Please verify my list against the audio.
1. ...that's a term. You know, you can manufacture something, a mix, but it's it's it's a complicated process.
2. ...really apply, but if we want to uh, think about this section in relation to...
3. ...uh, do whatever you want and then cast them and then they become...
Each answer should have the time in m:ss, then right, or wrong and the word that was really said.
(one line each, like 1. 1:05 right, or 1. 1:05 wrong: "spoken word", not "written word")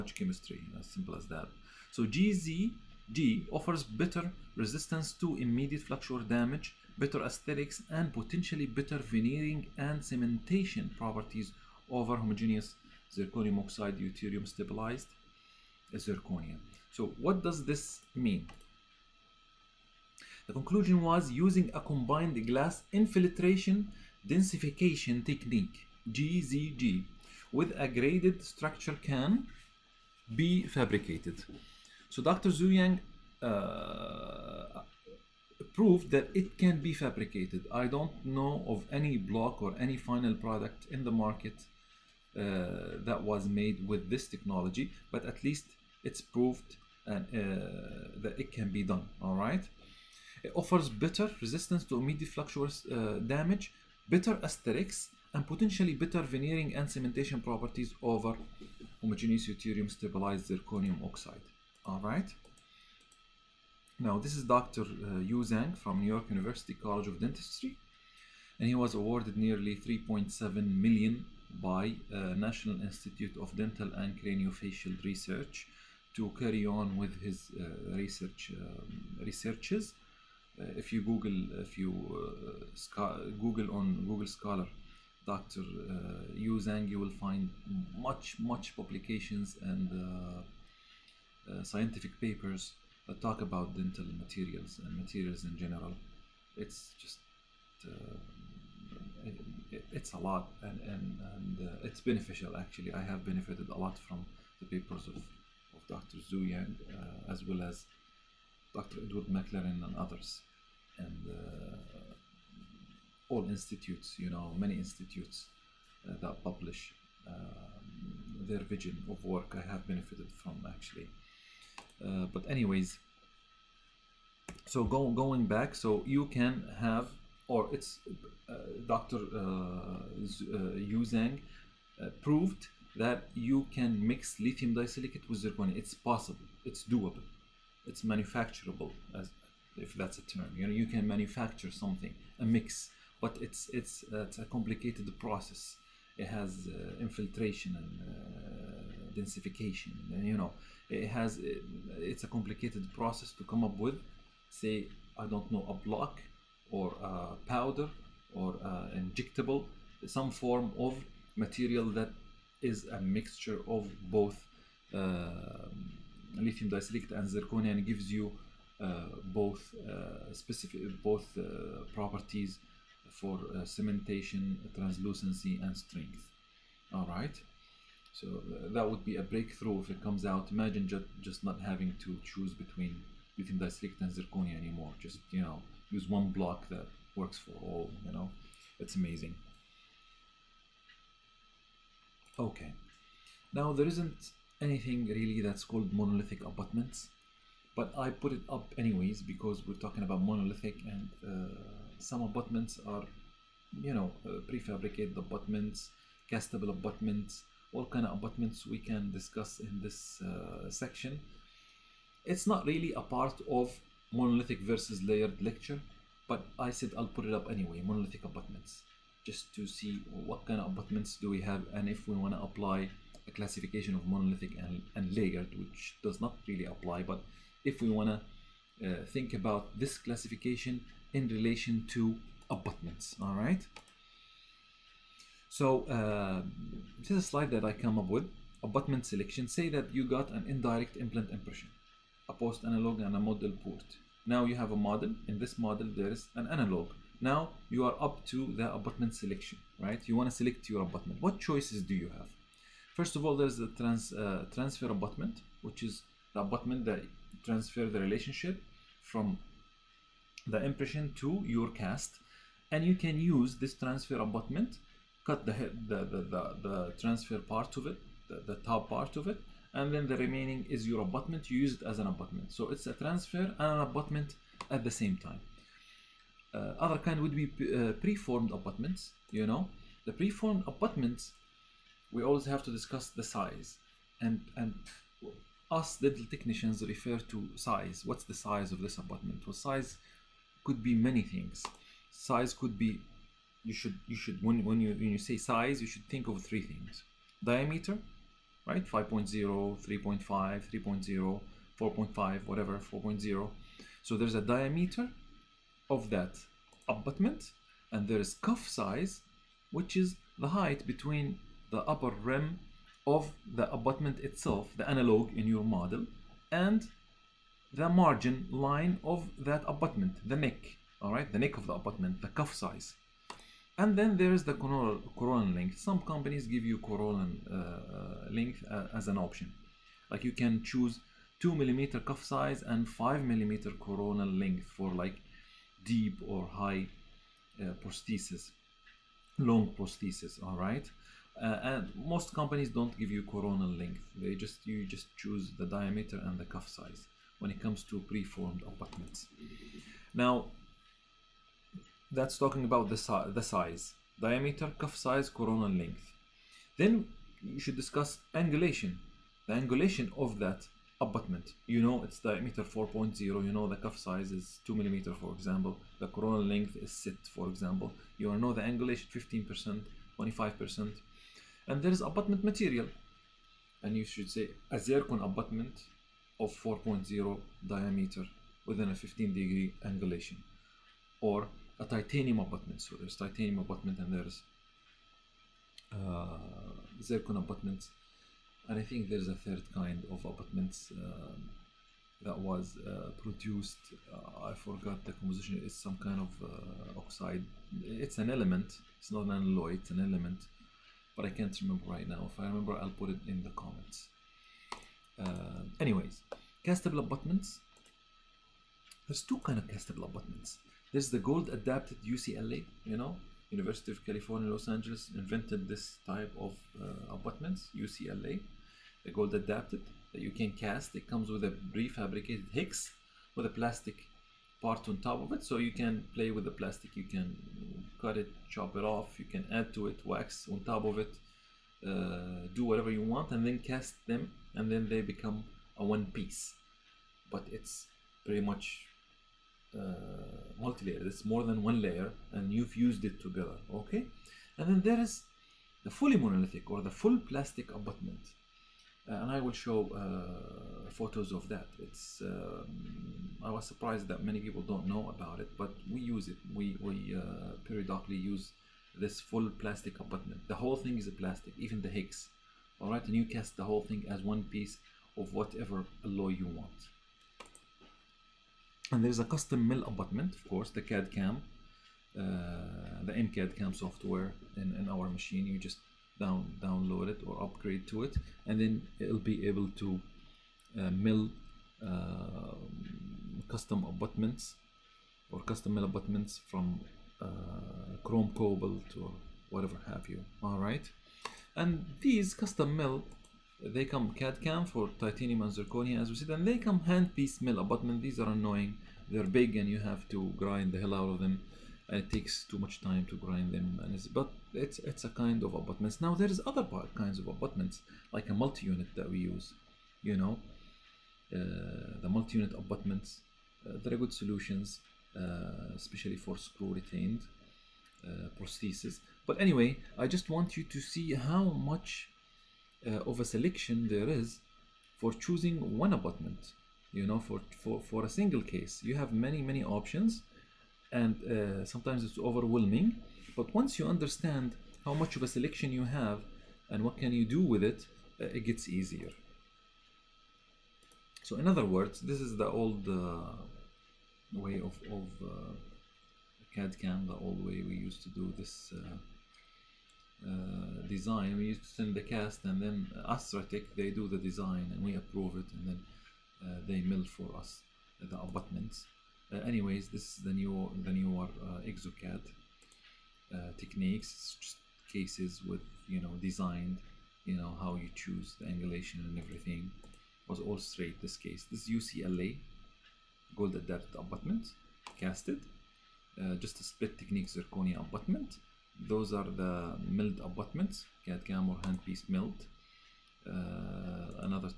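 1. 2:19 right
2. 3:46 wrong: "classification", not "section"
3. 7:11 right.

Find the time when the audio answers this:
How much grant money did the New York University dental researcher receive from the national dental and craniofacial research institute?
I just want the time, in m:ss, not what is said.
1:09.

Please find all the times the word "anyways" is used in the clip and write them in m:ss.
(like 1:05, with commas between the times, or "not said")
2:02, 3:18, 3:37, 6:45, 8:39, 9:19.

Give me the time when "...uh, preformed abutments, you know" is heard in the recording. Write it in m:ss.
4:37.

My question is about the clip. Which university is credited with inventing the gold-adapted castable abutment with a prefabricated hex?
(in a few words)
University of California, Los Angeles.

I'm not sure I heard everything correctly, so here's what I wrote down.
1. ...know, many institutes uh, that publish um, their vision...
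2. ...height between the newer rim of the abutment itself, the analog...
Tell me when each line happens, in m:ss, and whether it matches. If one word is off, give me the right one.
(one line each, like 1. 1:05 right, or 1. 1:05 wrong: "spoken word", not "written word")
1. 1:54 right
2. 5:10 wrong: "upper", not "newer".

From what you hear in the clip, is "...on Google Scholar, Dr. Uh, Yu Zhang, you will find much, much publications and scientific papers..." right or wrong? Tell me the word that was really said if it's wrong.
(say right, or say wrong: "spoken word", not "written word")
right.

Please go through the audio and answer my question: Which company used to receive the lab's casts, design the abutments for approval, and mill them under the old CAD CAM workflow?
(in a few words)
Astratech.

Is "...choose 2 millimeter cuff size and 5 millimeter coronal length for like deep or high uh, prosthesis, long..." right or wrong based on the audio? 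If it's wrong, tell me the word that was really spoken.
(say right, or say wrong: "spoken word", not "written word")
right.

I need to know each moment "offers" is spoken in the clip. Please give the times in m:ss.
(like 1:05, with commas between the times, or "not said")
0:03, 0:50.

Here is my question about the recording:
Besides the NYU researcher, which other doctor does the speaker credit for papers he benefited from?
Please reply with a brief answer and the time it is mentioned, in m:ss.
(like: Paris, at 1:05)
Edward McLaren, at 1:49.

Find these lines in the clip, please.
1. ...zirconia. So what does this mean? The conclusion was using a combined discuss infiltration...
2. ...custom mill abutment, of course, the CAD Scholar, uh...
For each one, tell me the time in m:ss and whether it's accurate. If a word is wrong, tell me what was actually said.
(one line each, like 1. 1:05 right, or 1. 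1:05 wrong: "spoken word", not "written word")
1. 0:15 wrong: "glass", not "discuss"
2. 7:49 wrong: "CAM", not "Scholar".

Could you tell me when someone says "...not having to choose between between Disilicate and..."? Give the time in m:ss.
3:01.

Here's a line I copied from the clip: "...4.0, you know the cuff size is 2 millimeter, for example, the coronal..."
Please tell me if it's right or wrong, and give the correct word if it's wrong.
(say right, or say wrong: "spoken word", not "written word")
right.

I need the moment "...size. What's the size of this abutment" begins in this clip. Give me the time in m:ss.
4:47.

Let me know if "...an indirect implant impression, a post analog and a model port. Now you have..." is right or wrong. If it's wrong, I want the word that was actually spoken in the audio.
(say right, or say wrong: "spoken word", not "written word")
right.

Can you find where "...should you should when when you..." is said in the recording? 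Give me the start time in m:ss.
4:53.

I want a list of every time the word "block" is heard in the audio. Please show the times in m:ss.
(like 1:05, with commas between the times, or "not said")
0:39, 2:35, 3:06.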